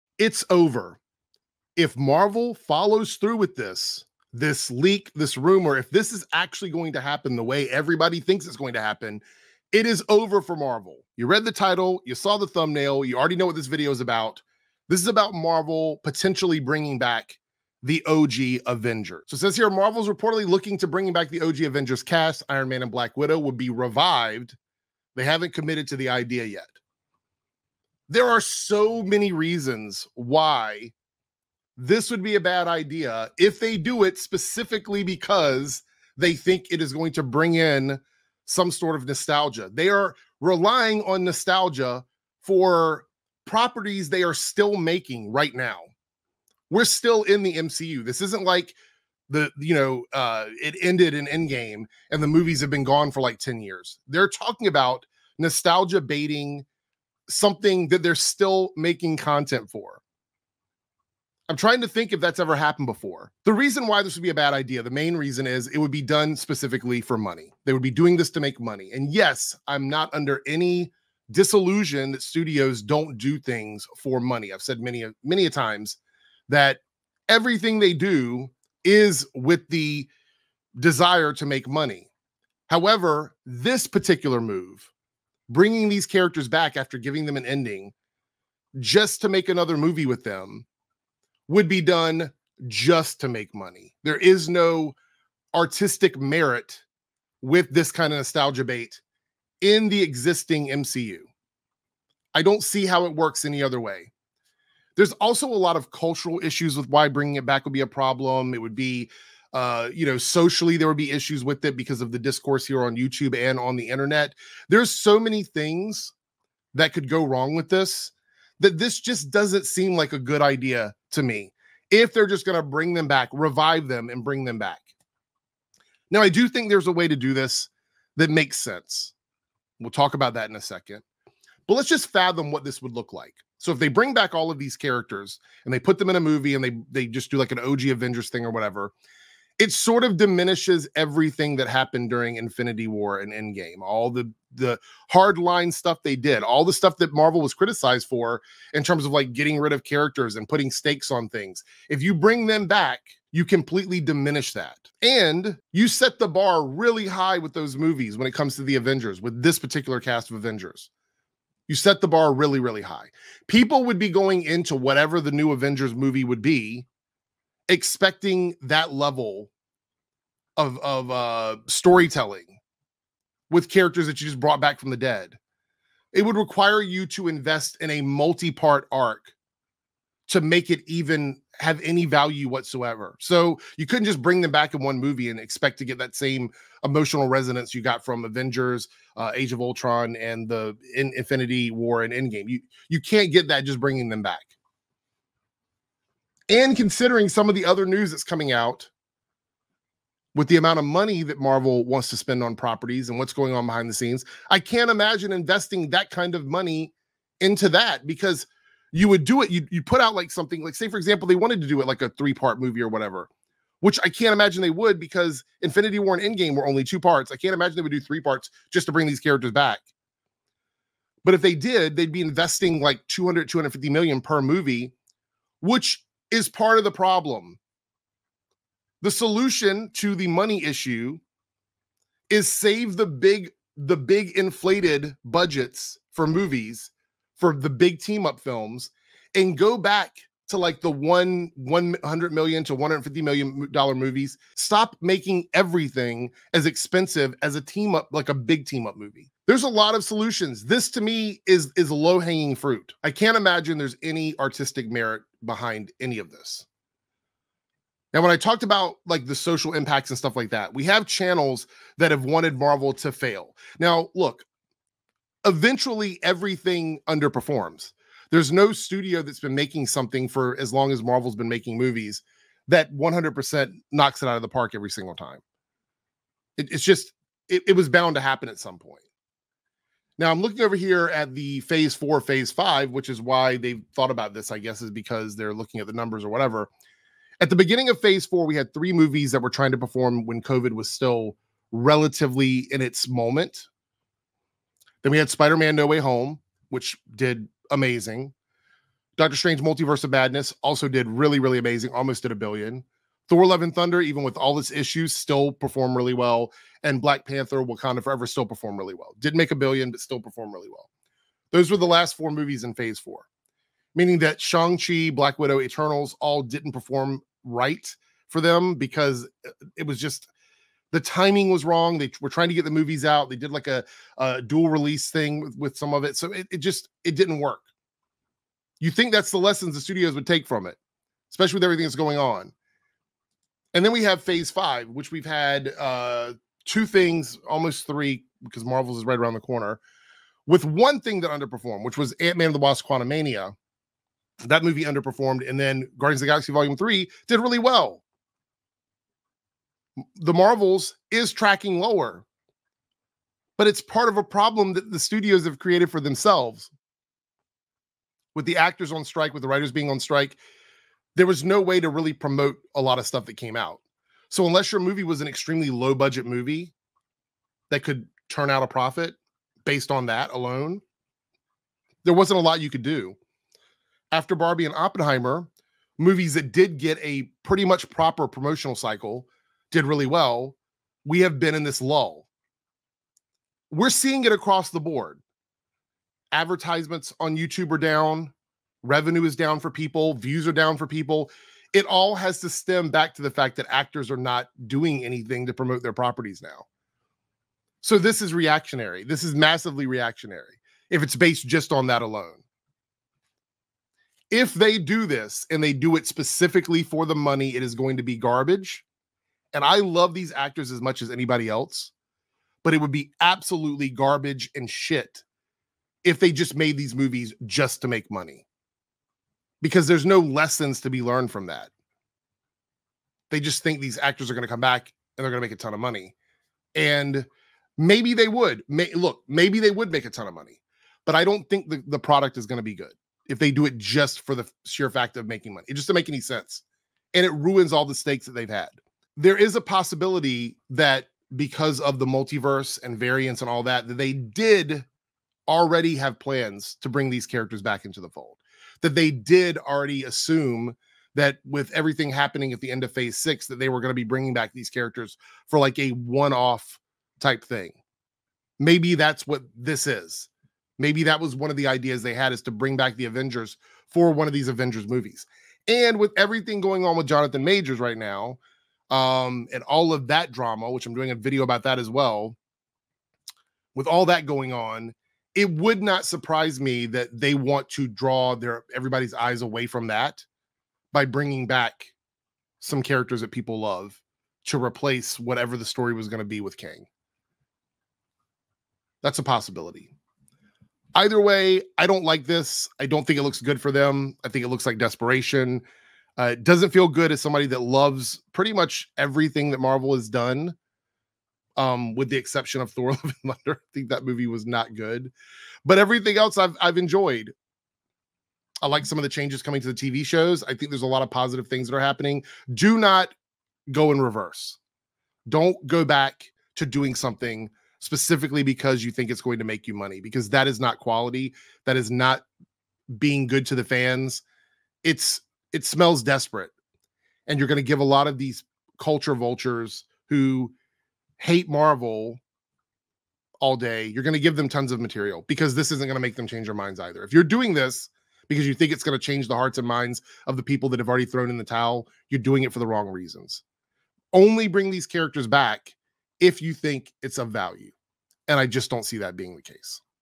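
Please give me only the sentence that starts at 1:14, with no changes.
I've said many many a times that everything they do is with the desire to make money.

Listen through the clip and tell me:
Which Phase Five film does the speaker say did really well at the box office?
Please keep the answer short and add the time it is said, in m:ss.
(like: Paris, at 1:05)
Guardians of the Galaxy Volume 3, at 5:45.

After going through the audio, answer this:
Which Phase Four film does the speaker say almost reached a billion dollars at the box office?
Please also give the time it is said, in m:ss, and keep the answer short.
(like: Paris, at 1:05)
Doctor Strange Multiverse of Madness, at 4:59.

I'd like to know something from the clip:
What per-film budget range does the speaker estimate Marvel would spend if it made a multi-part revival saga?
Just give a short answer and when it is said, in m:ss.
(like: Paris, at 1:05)
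200 250 million, at 3:43.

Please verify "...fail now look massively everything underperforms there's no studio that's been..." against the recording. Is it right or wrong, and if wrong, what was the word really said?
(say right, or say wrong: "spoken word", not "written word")
wrong: "eventually", not "massively".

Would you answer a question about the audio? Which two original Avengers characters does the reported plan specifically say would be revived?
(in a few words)
Iron Man and Black Widow.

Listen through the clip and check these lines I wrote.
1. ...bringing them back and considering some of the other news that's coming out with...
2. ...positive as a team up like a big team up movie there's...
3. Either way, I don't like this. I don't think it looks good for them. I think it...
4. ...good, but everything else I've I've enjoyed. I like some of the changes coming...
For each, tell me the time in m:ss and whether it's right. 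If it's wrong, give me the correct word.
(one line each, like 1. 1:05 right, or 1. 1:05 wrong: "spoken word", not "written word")
1. 3:13 right
2. 4:06 wrong: "expensive", not "positive"
3. 8:10 right
4. 8:24 right.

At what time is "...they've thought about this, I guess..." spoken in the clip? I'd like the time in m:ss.
4:43.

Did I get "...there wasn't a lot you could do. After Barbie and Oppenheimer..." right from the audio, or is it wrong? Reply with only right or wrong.
right.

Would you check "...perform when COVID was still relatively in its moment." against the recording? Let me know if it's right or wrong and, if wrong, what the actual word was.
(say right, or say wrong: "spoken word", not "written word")
right.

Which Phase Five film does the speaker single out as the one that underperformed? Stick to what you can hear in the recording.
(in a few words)
Ant-Man and the Wasp Quantumania.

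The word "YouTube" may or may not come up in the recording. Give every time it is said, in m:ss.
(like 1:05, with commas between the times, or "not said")
1:52, 6:27.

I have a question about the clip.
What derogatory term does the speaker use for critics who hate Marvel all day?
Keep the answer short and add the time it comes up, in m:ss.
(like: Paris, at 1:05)
culture vultures, at 8:48.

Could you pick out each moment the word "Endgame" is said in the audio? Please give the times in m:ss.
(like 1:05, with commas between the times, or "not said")
0:51, 2:23, 3:12, 3:36.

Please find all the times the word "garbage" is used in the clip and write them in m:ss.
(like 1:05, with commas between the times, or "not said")
6:48, 6:53.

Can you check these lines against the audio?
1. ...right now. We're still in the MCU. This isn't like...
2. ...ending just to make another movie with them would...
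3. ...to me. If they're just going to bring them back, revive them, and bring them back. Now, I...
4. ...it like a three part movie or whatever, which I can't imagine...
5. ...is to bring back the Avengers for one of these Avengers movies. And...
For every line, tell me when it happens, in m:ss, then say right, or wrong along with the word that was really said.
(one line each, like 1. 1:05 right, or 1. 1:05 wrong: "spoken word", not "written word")
1. 0:45 right
2. 1:27 right
3. 2:01 right
4. 3:31 right
5. 7:42 right.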